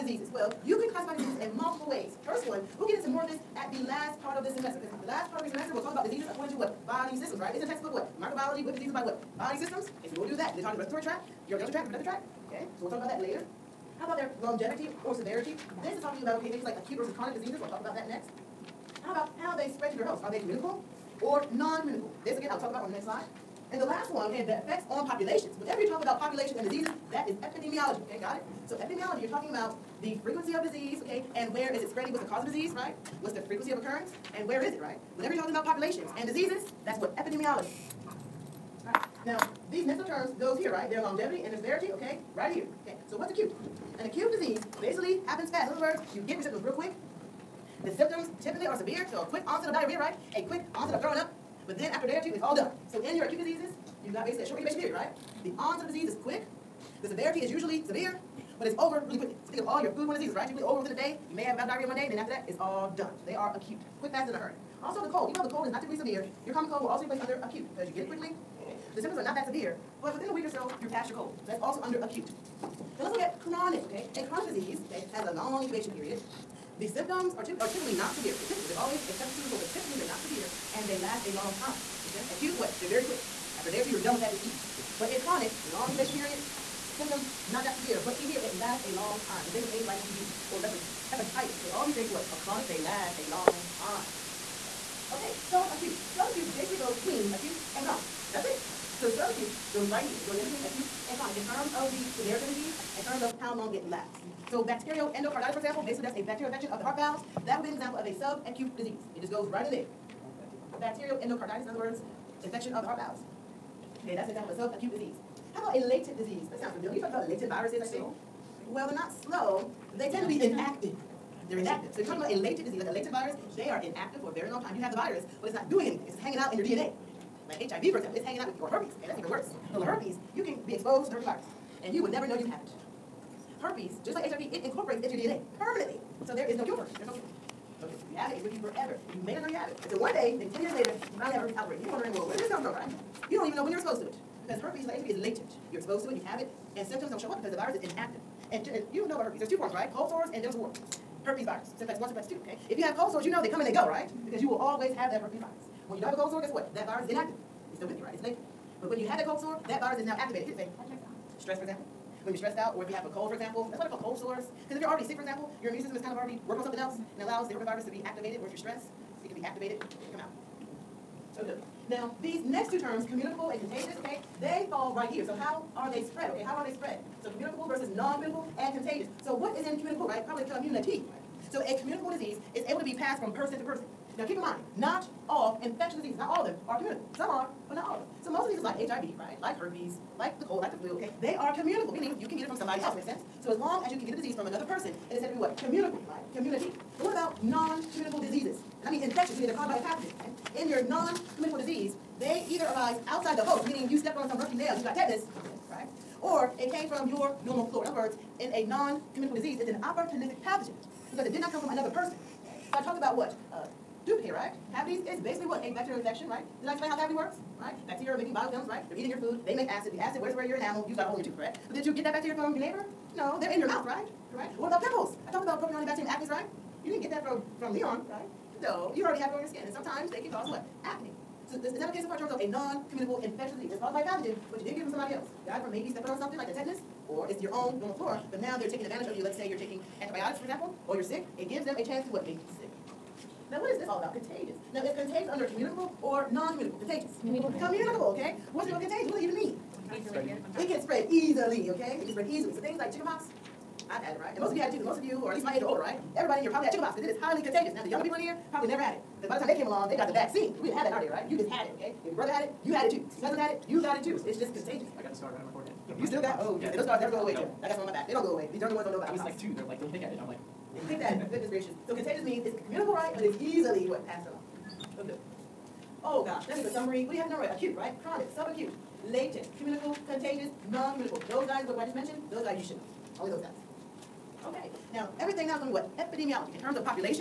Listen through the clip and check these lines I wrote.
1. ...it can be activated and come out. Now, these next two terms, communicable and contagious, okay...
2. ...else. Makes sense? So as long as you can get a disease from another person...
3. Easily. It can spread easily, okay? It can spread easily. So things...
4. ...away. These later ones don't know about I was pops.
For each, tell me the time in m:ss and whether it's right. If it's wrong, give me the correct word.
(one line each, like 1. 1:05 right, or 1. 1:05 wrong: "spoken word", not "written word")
1. 2:49 right
2. 3:12 right
3. 4:10 right
4. 4:28 wrong: "younger", not "later".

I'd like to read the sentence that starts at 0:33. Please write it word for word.
What's the frequency of occurrence, and where is it, right?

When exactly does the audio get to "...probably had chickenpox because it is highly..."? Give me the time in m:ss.
4:16.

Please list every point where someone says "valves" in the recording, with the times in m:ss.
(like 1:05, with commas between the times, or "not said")
1:46, 1:52.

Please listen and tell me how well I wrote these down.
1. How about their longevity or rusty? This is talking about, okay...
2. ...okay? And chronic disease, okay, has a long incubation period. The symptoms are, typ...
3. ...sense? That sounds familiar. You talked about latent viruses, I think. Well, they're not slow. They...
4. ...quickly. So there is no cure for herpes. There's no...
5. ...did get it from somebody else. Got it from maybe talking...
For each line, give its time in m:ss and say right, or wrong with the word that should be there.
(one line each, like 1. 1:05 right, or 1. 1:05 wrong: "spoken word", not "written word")
1. 0:13 wrong: "severity", not "rusty"
2. 1:13 right
3. 1:56 wrong: "disease", not "sense"
4. 2:15 wrong: "permanently", not "quickly"
5. 3:54 wrong: "stepping", not "talking".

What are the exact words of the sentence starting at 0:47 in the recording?
The symptoms typically are severe, so a quick onset of diarrhea, right?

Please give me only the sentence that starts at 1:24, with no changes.
But in chronic, long incubation period, symptoms not that severe, but here, it lasts a long time.